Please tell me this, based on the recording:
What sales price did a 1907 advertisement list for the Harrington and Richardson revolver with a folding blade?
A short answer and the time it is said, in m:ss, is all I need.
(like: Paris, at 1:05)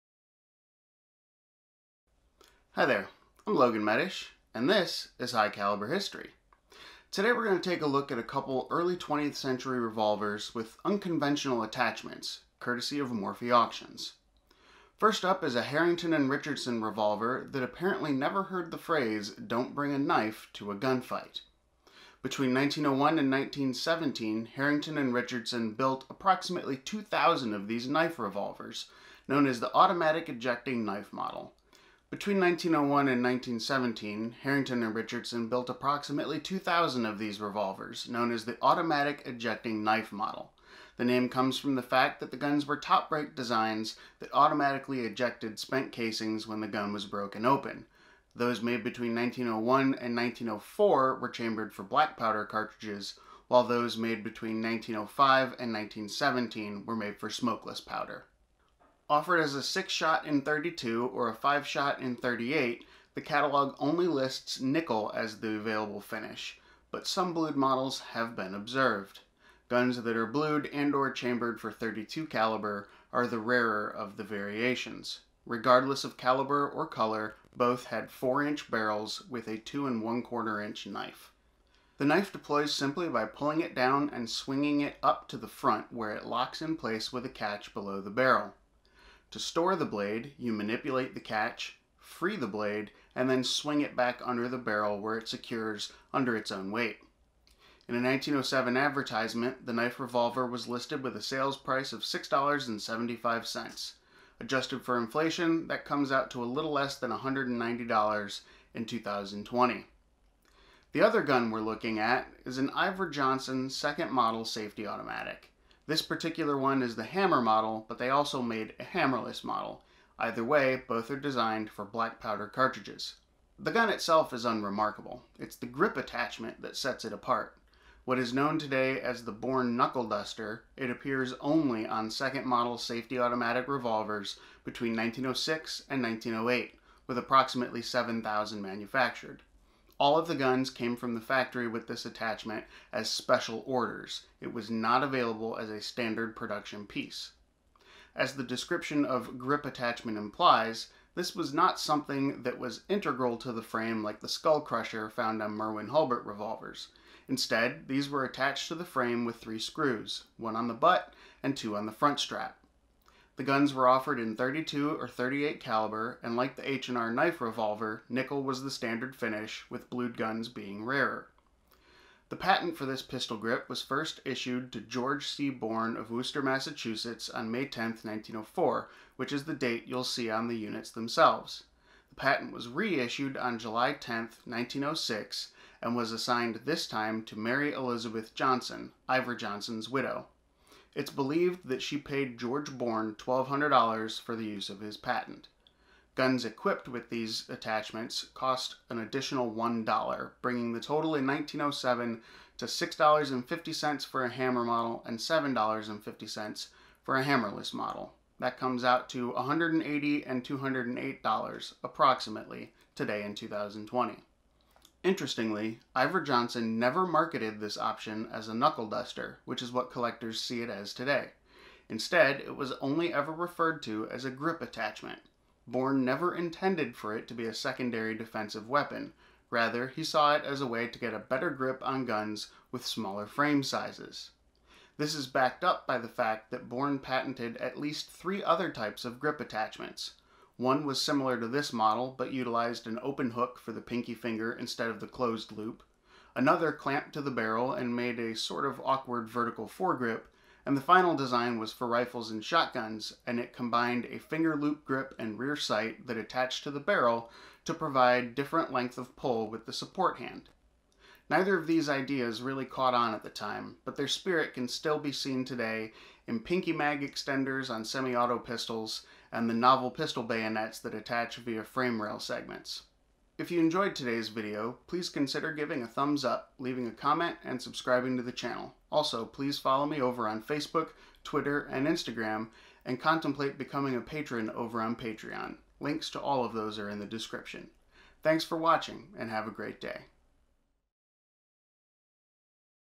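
$6.75, at 1:42.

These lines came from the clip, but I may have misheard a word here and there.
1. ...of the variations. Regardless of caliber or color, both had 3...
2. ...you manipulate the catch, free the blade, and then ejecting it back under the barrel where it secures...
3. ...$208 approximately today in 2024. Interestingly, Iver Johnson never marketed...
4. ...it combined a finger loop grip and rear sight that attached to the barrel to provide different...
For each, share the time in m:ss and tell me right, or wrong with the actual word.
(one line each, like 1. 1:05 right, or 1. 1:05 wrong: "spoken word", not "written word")
1. 1:13 wrong: "4", not "3"
2. 1:30 wrong: "swing", not "ejecting"
3. 3:30 wrong: "2020", not "2024"
4. 4:13 right.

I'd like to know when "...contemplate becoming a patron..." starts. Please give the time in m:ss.
4:42.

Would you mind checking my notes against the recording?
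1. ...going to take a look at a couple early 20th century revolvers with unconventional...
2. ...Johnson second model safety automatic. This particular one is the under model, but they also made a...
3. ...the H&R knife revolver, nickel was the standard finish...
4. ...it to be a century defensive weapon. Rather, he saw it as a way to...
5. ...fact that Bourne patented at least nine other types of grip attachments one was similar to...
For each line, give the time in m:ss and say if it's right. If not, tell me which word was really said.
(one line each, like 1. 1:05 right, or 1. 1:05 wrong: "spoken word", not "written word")
1. 0:07 right
2. 1:53 wrong: "hammer", not "under"
3. 2:46 right
4. 3:47 wrong: "secondary", not "century"
5. 3:56 wrong: "three", not "nine".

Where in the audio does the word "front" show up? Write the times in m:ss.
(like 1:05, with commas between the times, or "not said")
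1:25, 2:41.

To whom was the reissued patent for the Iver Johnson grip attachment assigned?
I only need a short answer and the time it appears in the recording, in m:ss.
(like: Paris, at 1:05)
Mary Elizabeth Johnson, at 3:07.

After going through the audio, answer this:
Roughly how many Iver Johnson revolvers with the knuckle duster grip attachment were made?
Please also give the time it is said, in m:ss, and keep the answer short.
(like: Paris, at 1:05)
7,000, at 2:17.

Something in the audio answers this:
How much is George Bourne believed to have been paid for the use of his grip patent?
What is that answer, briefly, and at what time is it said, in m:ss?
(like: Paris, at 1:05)
$1,200, at 3:13.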